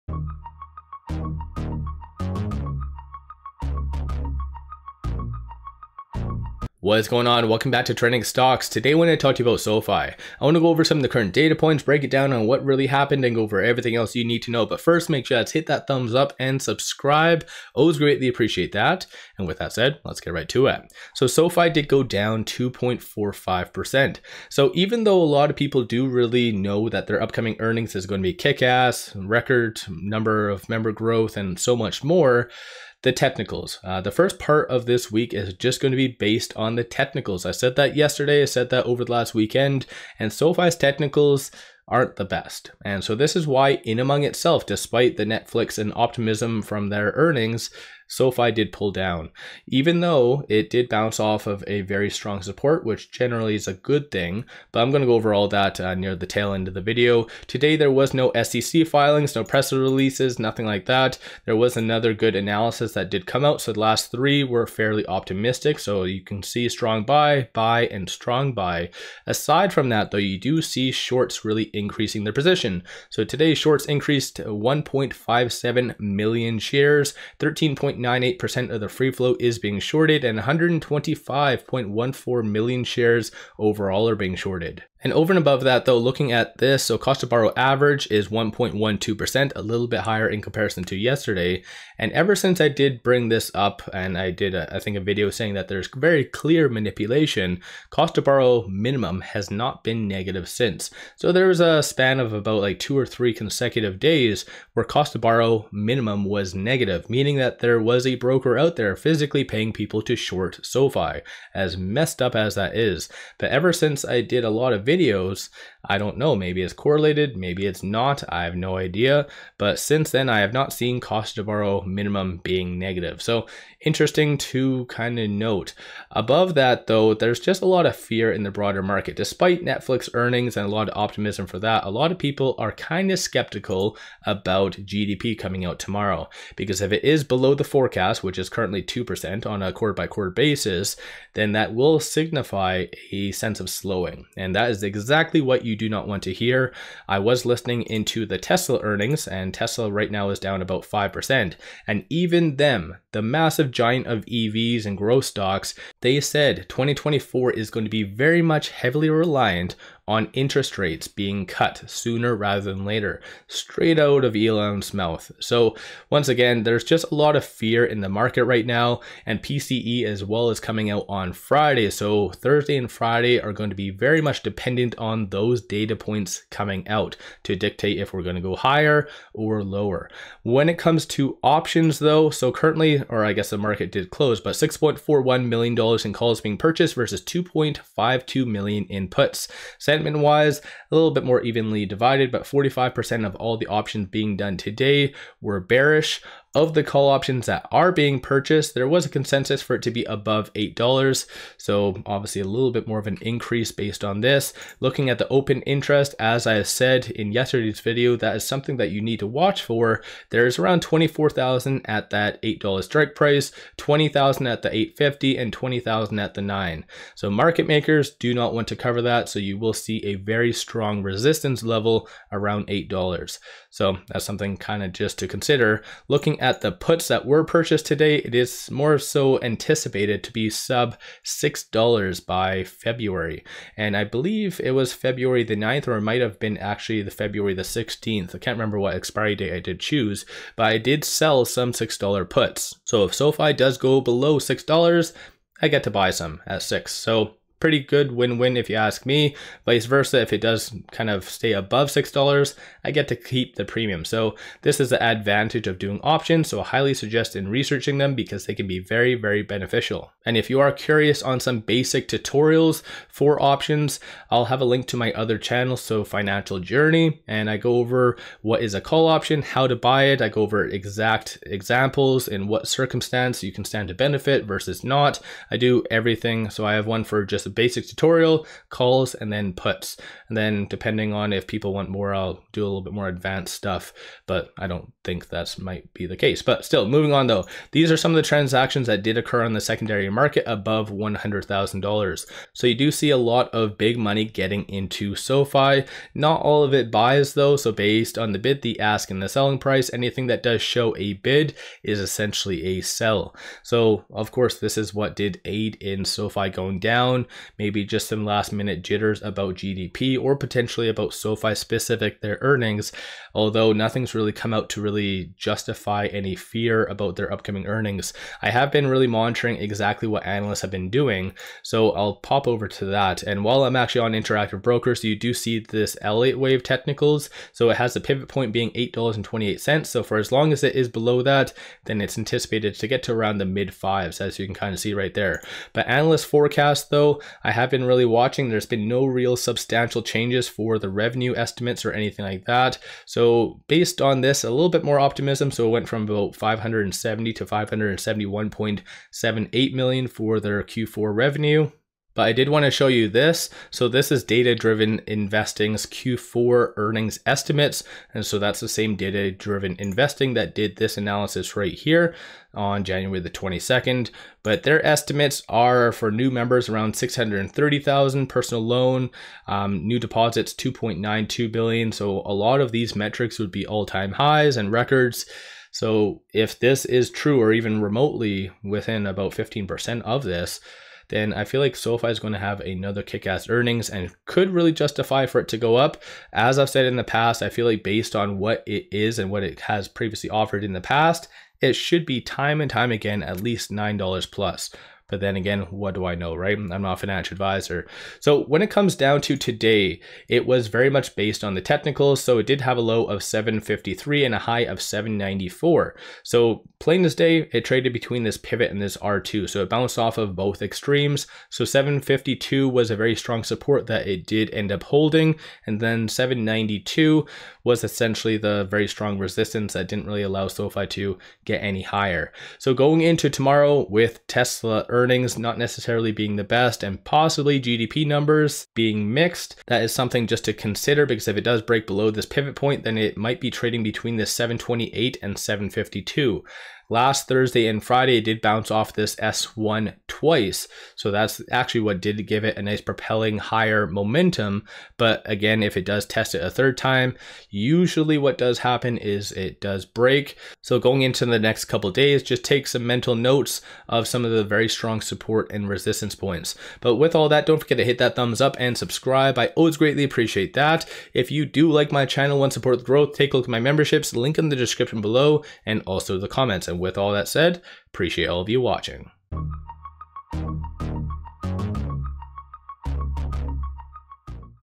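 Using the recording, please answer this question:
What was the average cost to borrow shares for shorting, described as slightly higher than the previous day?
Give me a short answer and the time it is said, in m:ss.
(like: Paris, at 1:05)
1.12%, at 1:28.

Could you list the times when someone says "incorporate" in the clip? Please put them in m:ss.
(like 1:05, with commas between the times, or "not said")
not said.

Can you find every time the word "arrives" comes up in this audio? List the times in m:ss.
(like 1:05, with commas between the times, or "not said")
not said.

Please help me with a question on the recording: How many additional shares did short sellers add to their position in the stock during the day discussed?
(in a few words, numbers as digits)
1.57 million.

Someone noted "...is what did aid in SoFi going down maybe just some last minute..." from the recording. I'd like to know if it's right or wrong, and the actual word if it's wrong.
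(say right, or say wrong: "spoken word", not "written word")
right.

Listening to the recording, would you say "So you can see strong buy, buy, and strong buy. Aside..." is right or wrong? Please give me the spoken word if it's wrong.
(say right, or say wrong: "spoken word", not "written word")
right.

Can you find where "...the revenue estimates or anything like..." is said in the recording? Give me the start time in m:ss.
5:40.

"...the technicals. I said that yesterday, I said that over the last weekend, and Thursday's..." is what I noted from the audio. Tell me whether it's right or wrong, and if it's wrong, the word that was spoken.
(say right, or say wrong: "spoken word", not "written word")
wrong: "SoFi", not "Thursday".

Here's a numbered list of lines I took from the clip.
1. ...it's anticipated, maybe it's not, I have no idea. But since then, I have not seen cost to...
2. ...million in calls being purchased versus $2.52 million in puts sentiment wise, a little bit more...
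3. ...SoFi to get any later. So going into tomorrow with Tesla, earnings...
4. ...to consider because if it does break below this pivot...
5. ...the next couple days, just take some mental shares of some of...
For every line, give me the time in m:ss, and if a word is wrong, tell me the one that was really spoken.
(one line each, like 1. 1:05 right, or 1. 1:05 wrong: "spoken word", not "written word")
1. 1:56 wrong: "correlated", not "anticipated"
2. 3:05 right
3. 7:00 wrong: "higher", not "later"
4. 7:10 right
5. 7:31 wrong: "notes", not "shares".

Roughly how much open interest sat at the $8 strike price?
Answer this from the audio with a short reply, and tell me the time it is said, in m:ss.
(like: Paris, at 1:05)
24,000, at 3:30.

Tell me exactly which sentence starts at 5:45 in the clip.
So it went from about 570 to 571.78 million for their Q4 revenue.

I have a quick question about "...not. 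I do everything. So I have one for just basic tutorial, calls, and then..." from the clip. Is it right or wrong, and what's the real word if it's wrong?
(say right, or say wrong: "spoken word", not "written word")
right.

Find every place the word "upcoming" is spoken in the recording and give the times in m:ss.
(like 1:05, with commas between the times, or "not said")
0:27, 5:17.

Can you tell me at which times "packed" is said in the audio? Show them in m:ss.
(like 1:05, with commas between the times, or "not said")
not said.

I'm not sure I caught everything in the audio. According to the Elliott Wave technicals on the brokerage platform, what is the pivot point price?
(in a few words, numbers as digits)
$8.28.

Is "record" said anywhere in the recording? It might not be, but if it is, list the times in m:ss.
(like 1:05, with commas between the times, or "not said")
0:29, 6:14.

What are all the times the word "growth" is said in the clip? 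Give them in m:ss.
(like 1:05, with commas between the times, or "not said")
0:30, 2:34, 7:42.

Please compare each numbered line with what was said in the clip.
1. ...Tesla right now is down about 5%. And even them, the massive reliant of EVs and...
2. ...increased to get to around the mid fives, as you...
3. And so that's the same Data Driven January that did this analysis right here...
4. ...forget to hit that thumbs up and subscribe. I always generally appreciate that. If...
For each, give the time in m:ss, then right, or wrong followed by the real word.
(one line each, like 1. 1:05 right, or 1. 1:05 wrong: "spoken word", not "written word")
1. 2:29 wrong: "giant", not "reliant"
2. 5:32 wrong: "anticipated", not "increased"
3. 5:58 wrong: "Investing", not "January"
4. 7:37 wrong: "greatly", not "generally".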